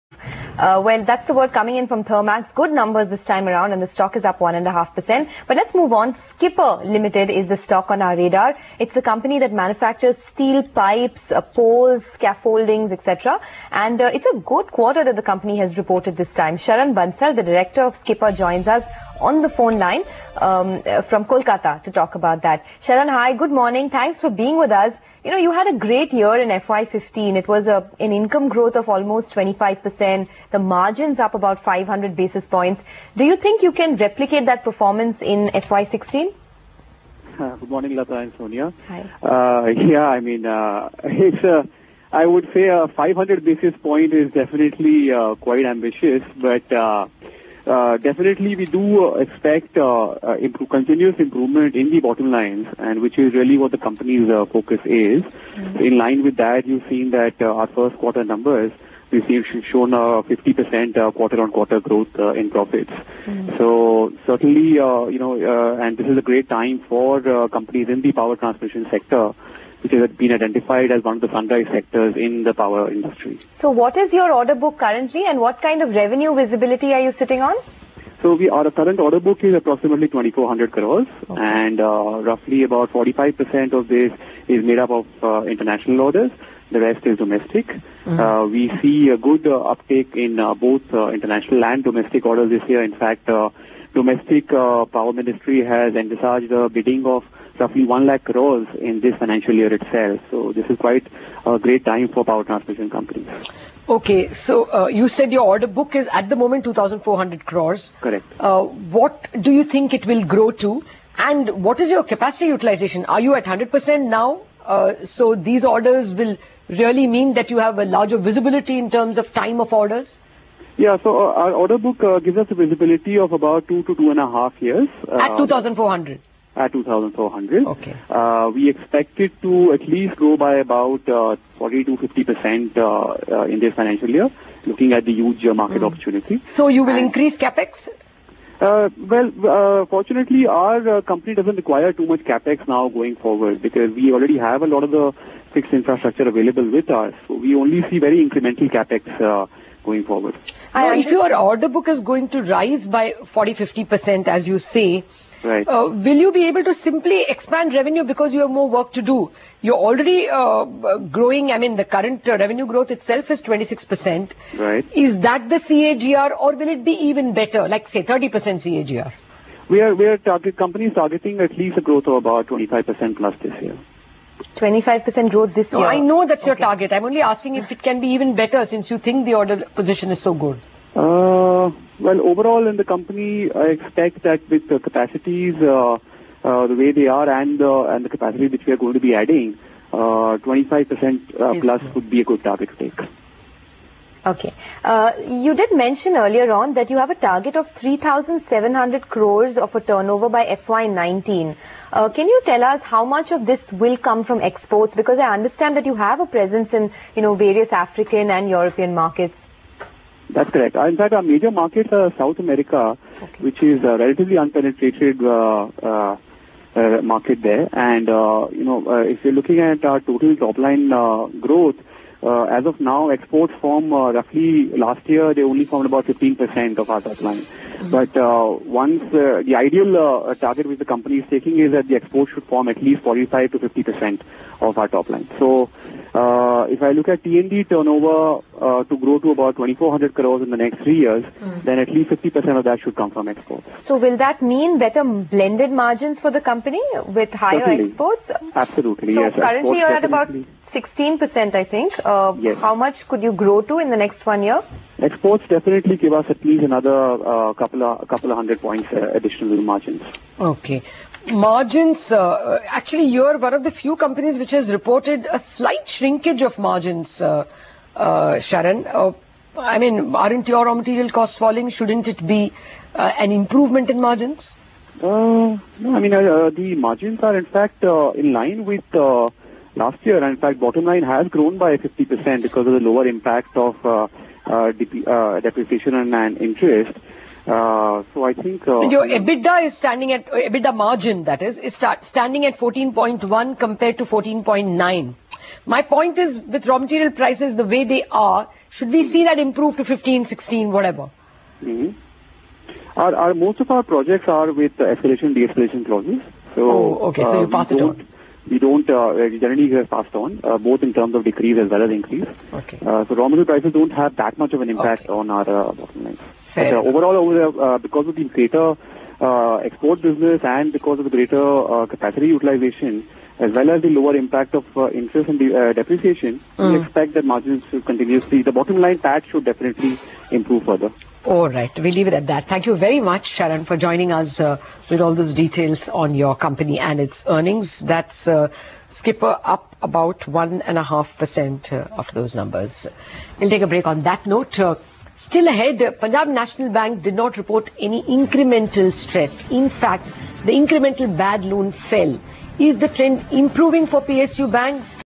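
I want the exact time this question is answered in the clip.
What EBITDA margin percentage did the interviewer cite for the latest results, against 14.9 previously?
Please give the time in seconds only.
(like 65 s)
292 s.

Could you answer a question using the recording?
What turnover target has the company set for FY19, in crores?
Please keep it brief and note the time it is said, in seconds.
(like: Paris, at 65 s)
3,700 crores, at 197 s.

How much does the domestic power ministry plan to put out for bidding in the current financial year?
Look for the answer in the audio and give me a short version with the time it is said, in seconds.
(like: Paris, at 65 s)
1 lakh crores, at 97 s.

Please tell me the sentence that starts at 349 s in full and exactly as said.
In fact, the incremental bad loan fell is the trend improving for PSU banks?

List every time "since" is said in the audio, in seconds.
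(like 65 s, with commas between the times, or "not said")
178 s.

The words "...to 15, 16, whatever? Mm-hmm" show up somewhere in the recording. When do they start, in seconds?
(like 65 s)
299 s.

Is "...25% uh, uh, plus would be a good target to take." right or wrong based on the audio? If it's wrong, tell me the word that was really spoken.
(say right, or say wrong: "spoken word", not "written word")
right.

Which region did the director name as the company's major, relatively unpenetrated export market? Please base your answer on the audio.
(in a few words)
South America.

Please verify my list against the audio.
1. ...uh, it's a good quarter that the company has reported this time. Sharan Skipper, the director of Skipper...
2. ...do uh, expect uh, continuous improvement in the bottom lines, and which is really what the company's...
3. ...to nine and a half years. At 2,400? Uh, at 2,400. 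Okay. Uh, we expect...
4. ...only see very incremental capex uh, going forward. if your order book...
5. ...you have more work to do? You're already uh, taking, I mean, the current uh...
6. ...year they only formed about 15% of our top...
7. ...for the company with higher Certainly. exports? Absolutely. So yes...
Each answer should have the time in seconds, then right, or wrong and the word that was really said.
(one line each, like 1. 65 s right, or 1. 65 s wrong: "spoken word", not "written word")
1. 14 s wrong: "Bansal", not "Skipper"
2. 48 s right
3. 123 s wrong: "two", not "nine"
4. 147 s right
5. 158 s wrong: "growing", not "taking"
6. 225 s right
7. 246 s right.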